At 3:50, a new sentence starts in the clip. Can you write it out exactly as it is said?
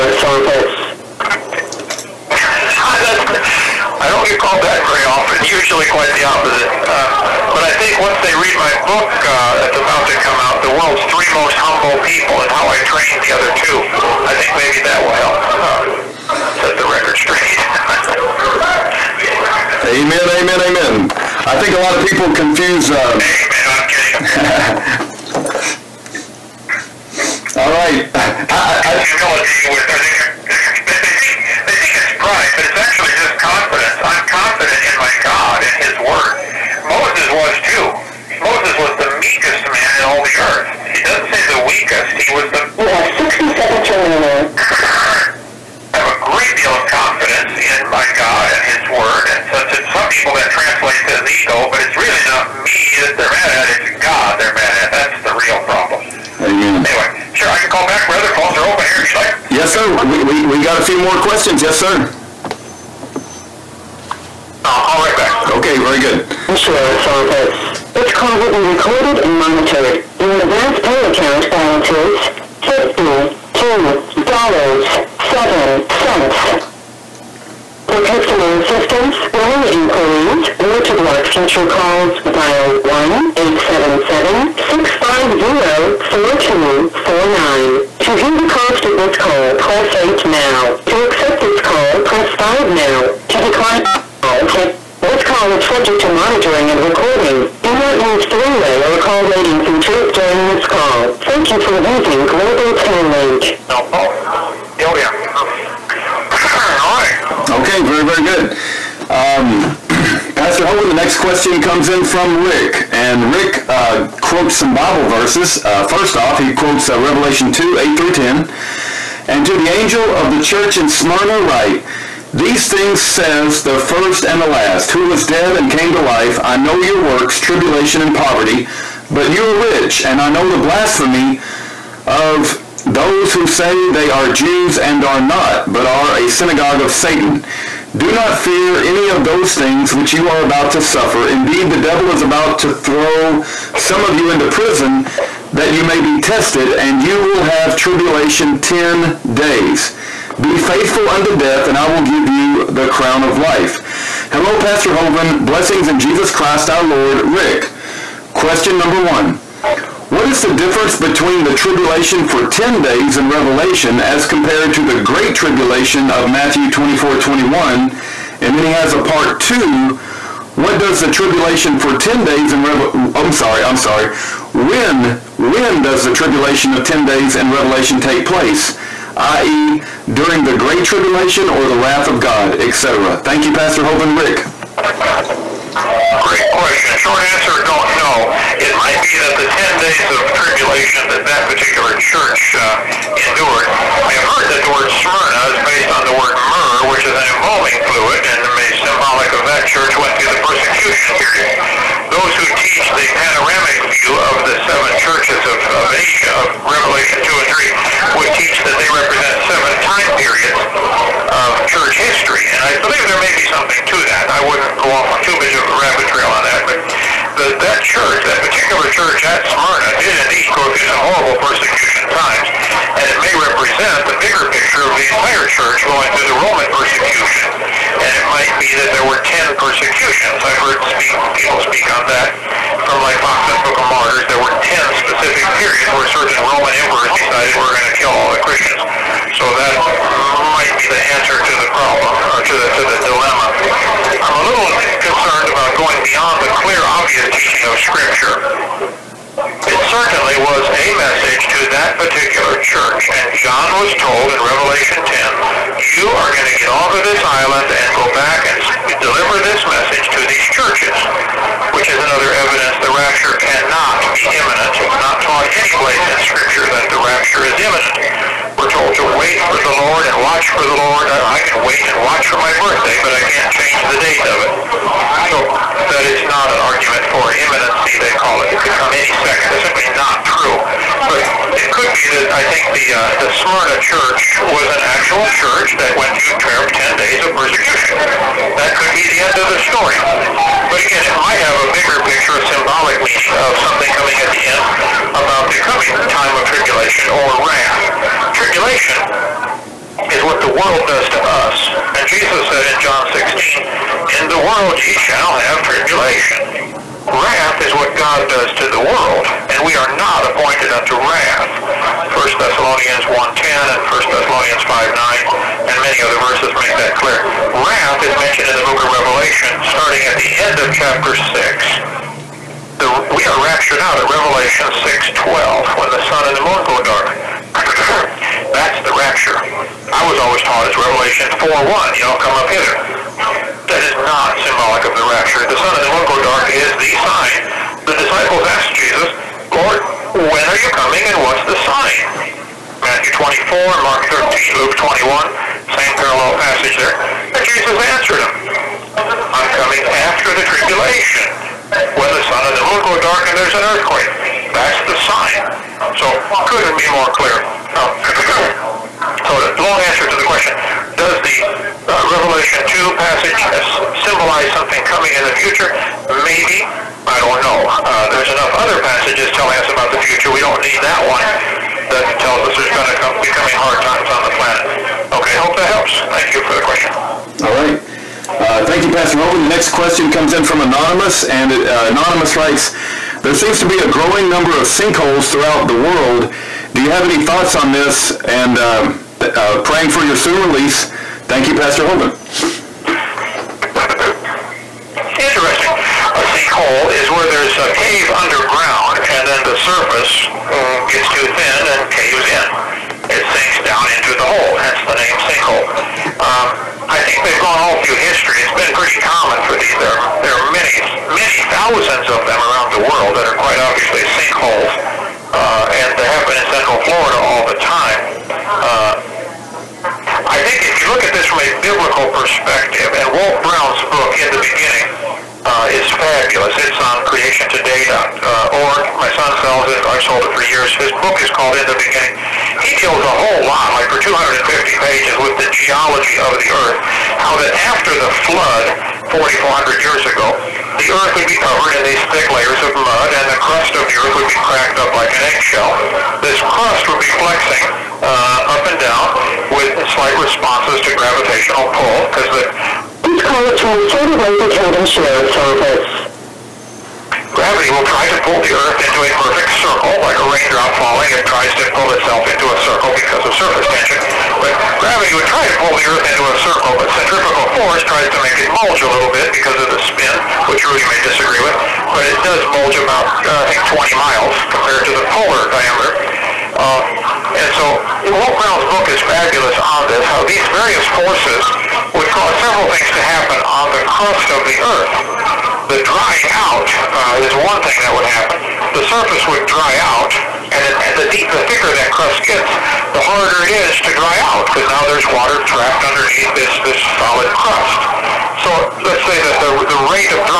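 I've heard speak, people speak on that from like Foxe's Book of Martyrs.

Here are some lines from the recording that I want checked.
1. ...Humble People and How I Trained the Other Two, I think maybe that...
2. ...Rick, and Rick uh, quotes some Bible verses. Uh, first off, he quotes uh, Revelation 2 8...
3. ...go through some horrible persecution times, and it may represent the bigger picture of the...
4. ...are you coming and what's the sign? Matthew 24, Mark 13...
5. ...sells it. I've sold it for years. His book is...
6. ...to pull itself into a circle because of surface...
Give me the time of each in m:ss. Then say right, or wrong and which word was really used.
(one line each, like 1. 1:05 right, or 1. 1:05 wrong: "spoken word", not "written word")
1. 0:11 right
2. 1:52 right
3. 3:40 right
4. 5:40 right
5. 7:09 right
6. 7:41 right.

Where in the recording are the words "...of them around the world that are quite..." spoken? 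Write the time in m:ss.
6:52.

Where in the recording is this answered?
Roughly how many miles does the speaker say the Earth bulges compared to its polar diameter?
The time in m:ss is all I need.
7:53.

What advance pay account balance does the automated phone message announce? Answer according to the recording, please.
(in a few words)
$52.07.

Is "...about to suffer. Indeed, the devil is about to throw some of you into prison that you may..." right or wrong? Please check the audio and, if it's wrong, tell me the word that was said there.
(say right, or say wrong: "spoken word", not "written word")
right.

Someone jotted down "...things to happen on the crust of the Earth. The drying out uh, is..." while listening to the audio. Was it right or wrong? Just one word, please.
right.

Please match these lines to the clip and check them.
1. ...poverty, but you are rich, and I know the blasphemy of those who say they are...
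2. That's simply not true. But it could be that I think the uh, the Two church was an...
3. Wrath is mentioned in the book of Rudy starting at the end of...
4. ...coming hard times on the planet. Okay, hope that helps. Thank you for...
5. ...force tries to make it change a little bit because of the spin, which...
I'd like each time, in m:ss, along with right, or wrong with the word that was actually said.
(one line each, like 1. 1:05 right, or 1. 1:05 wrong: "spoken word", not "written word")
1. 2:08 right
2. 4:39 wrong: "Smyrna", not "Two"
3. 5:17 wrong: "Revelation", not "Rudy"
4. 6:13 right
5. 7:47 wrong: "bulge", not "change".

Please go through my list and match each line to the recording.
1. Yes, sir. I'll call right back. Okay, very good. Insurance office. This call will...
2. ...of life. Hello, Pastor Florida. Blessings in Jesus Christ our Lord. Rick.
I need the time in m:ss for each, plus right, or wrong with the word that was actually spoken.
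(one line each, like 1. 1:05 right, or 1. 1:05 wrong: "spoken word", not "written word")
1. 1:01 right
2. 2:33 wrong: "Hovind", not "Florida".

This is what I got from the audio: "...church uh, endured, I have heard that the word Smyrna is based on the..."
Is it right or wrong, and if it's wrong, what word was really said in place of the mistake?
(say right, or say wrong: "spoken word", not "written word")
right.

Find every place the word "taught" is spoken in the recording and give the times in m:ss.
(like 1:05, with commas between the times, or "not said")
4:25, 5:30.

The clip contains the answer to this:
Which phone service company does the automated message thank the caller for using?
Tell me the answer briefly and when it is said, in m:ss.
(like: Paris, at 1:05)
Global Tel Link, at 1:42.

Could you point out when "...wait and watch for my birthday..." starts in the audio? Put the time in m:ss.
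4:31.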